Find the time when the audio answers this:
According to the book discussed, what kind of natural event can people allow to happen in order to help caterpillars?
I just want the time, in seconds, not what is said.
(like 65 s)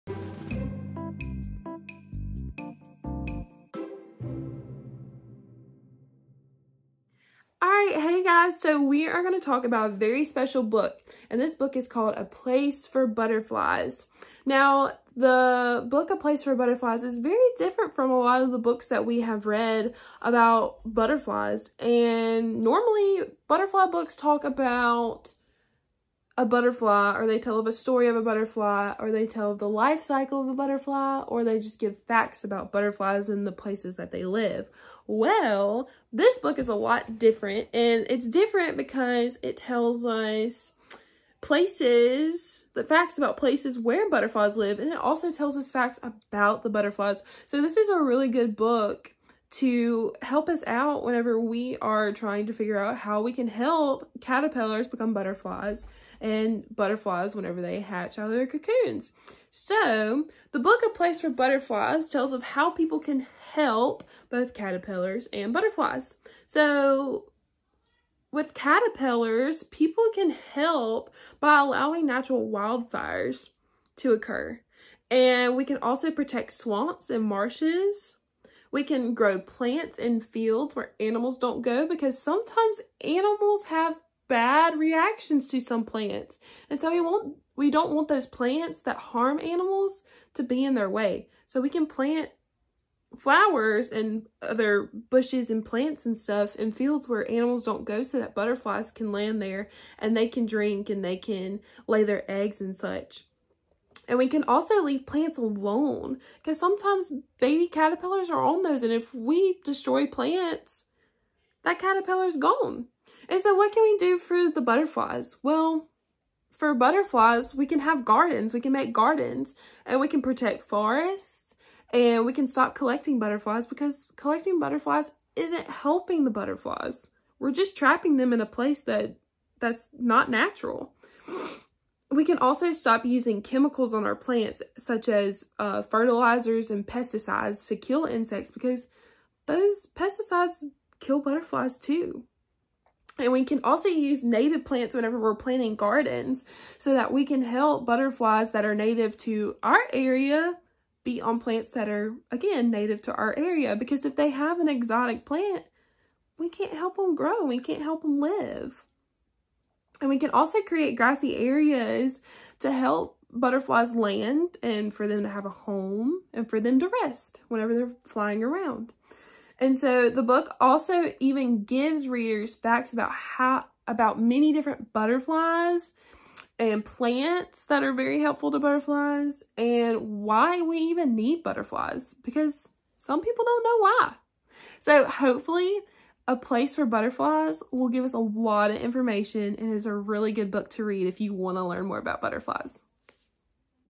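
72 s.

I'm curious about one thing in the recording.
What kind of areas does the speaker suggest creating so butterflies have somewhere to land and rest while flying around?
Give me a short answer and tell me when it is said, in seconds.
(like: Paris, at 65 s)
grassy areas, at 160 s.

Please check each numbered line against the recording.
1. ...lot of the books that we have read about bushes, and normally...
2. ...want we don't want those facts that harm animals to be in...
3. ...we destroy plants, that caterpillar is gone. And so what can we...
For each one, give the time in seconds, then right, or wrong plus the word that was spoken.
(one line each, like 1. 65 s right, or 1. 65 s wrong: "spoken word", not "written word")
1. 18 s wrong: "butterflies", not "bushes"
2. 87 s wrong: "plants", not "facts"
3. 109 s right.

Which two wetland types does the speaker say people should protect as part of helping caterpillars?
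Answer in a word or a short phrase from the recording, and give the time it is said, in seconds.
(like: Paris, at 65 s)
swamps and marshes, at 76 s.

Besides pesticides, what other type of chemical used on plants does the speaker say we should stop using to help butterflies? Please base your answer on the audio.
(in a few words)
fertilizers.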